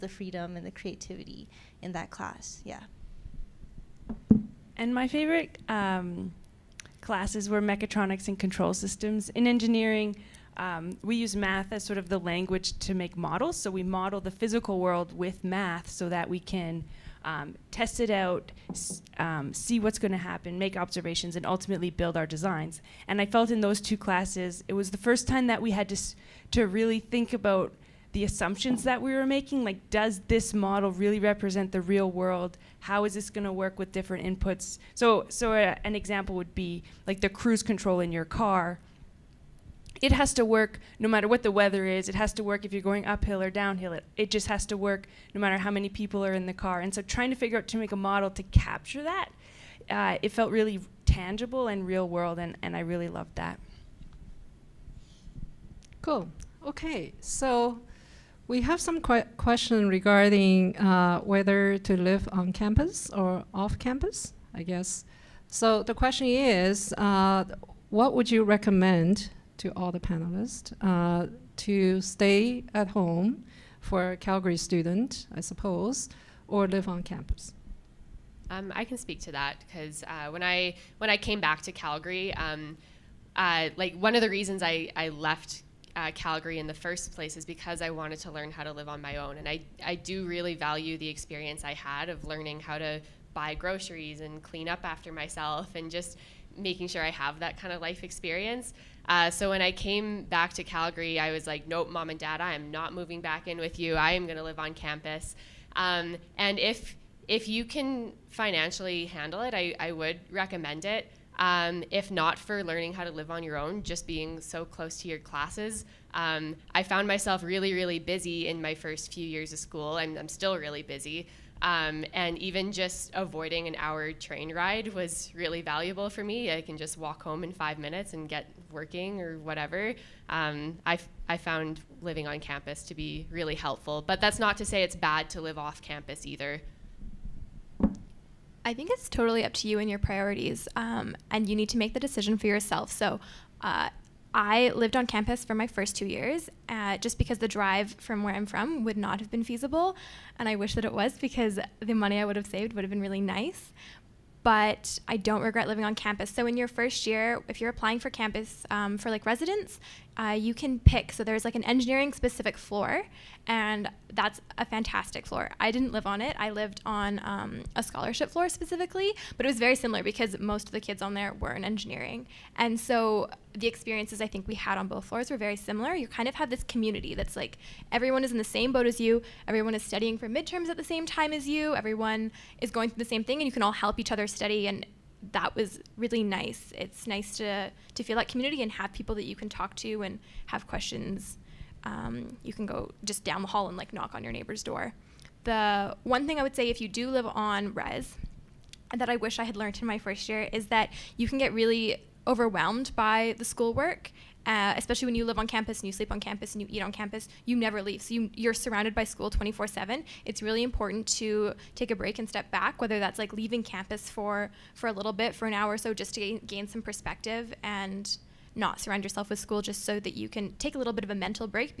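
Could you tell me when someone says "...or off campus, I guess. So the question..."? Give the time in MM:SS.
01:03.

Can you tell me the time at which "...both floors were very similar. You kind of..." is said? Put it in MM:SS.
02:54.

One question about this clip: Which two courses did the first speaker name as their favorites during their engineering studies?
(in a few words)
Mechatronics and control systems.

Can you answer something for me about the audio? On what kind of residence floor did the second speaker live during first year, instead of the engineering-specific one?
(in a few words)
A scholarship floor.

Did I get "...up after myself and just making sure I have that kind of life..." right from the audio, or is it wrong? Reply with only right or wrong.
right.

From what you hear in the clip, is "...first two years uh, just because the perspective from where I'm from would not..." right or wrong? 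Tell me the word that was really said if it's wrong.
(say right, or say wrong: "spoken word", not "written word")
wrong: "drive", not "perspective".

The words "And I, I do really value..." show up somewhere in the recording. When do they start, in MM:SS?
01:29.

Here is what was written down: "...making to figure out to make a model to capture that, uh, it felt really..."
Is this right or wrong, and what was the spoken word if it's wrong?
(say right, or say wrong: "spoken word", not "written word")
wrong: "trying", not "making".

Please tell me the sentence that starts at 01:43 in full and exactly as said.
I am going to live on campus.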